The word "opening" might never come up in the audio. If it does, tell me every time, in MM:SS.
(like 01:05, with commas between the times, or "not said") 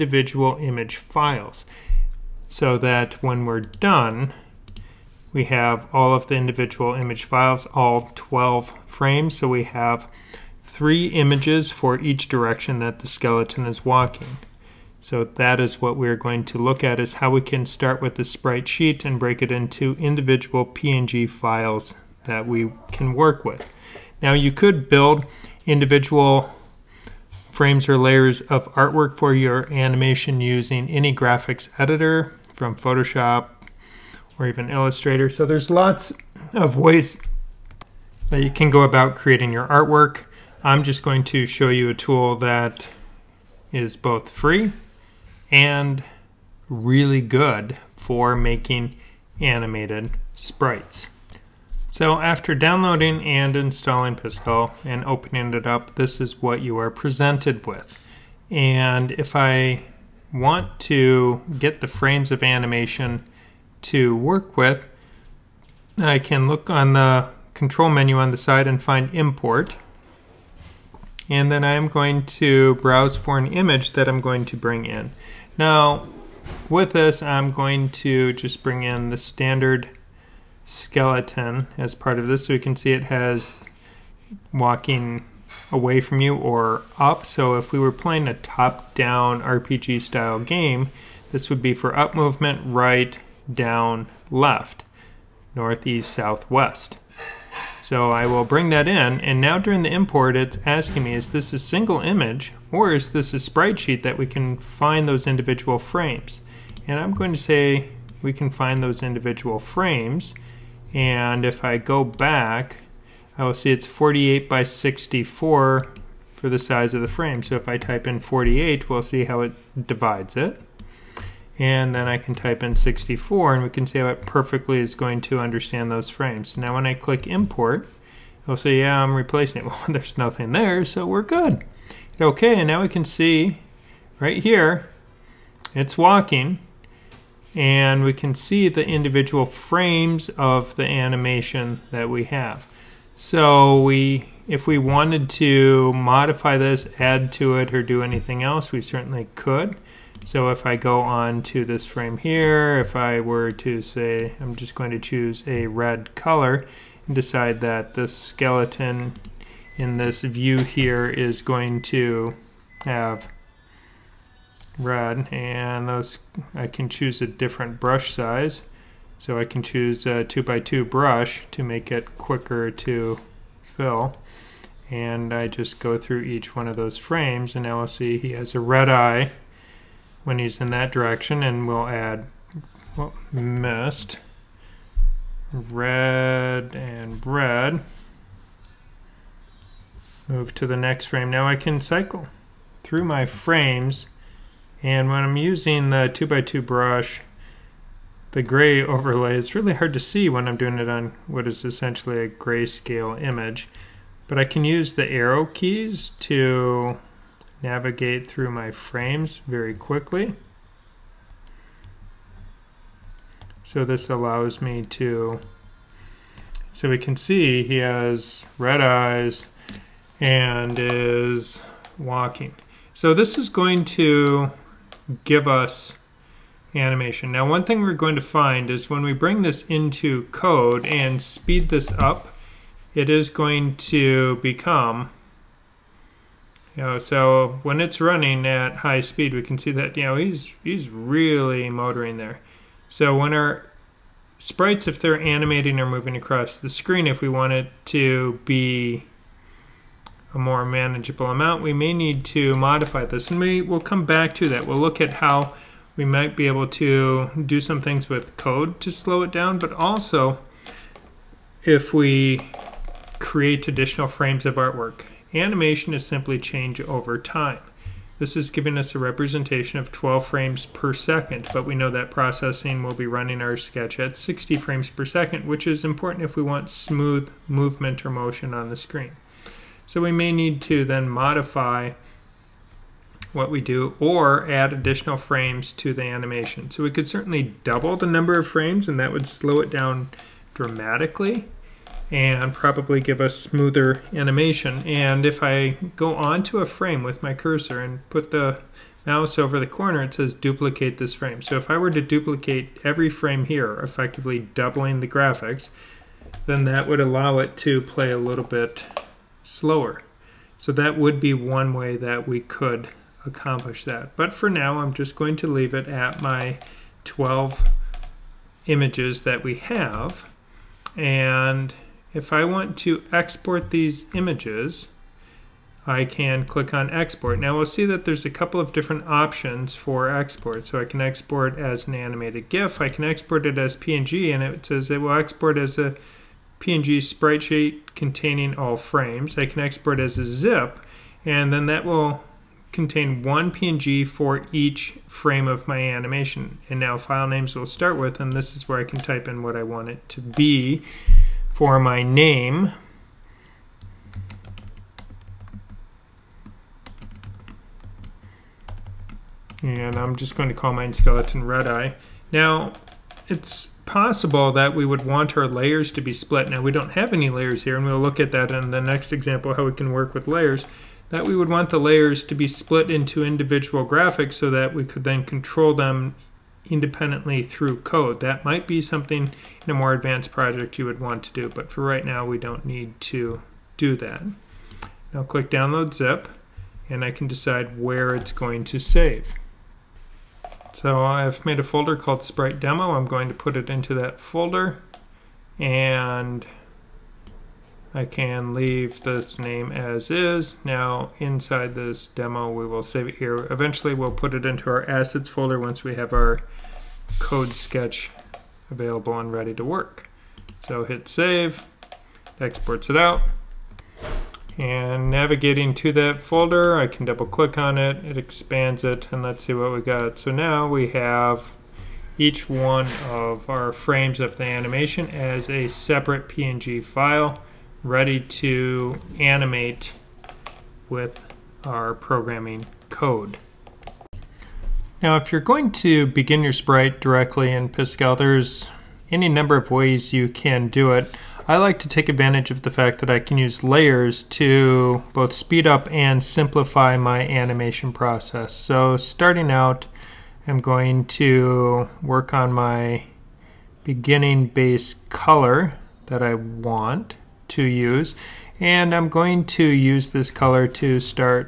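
00:55.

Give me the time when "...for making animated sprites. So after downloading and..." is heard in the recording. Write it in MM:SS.
00:47.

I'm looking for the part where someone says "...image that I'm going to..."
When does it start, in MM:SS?
01:13.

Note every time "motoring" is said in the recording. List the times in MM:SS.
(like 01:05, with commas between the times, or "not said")
04:01.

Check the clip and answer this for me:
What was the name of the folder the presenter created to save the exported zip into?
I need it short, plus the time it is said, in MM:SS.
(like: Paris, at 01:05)
Sprite Demo, at 06:32.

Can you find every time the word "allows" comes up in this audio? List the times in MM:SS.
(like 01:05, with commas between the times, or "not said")
03:34, 05:06.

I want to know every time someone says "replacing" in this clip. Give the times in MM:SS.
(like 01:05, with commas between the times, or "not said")
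02:09.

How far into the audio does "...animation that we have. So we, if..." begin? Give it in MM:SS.
02:20.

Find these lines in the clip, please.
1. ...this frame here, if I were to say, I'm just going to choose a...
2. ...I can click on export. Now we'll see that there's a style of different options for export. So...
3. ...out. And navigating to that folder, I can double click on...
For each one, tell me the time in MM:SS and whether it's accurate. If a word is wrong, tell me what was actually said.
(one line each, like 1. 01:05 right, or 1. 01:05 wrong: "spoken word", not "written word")
1. 02:31 right
2. 05:25 wrong: "couple", not "style"
3. 06:52 right.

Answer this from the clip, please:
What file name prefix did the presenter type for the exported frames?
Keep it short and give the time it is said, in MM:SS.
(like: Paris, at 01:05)
skeleton red eye, at 06:00.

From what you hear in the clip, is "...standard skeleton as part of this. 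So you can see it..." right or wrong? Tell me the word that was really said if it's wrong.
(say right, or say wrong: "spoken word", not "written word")
right.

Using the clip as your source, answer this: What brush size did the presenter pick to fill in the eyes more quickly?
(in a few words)
2 by 2.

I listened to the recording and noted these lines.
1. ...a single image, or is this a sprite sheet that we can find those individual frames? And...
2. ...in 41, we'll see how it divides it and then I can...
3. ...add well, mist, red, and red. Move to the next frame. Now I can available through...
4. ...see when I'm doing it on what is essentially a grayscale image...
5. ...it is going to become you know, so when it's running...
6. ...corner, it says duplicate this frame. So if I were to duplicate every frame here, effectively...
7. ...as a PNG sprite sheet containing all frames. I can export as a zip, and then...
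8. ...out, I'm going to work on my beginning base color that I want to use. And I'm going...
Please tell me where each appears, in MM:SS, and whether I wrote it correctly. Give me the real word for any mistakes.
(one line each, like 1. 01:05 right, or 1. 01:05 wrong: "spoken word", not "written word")
1. 01:41 right
2. 01:58 wrong: "48", not "41"
3. 03:01 wrong: "cycle", not "available"
4. 03:19 right
5. 03:52 right
6. 04:59 right
7. 05:35 right
8. 07:29 right.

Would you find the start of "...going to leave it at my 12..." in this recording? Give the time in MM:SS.
05:15.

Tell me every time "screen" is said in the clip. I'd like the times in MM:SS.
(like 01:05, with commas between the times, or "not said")
04:06, 04:38.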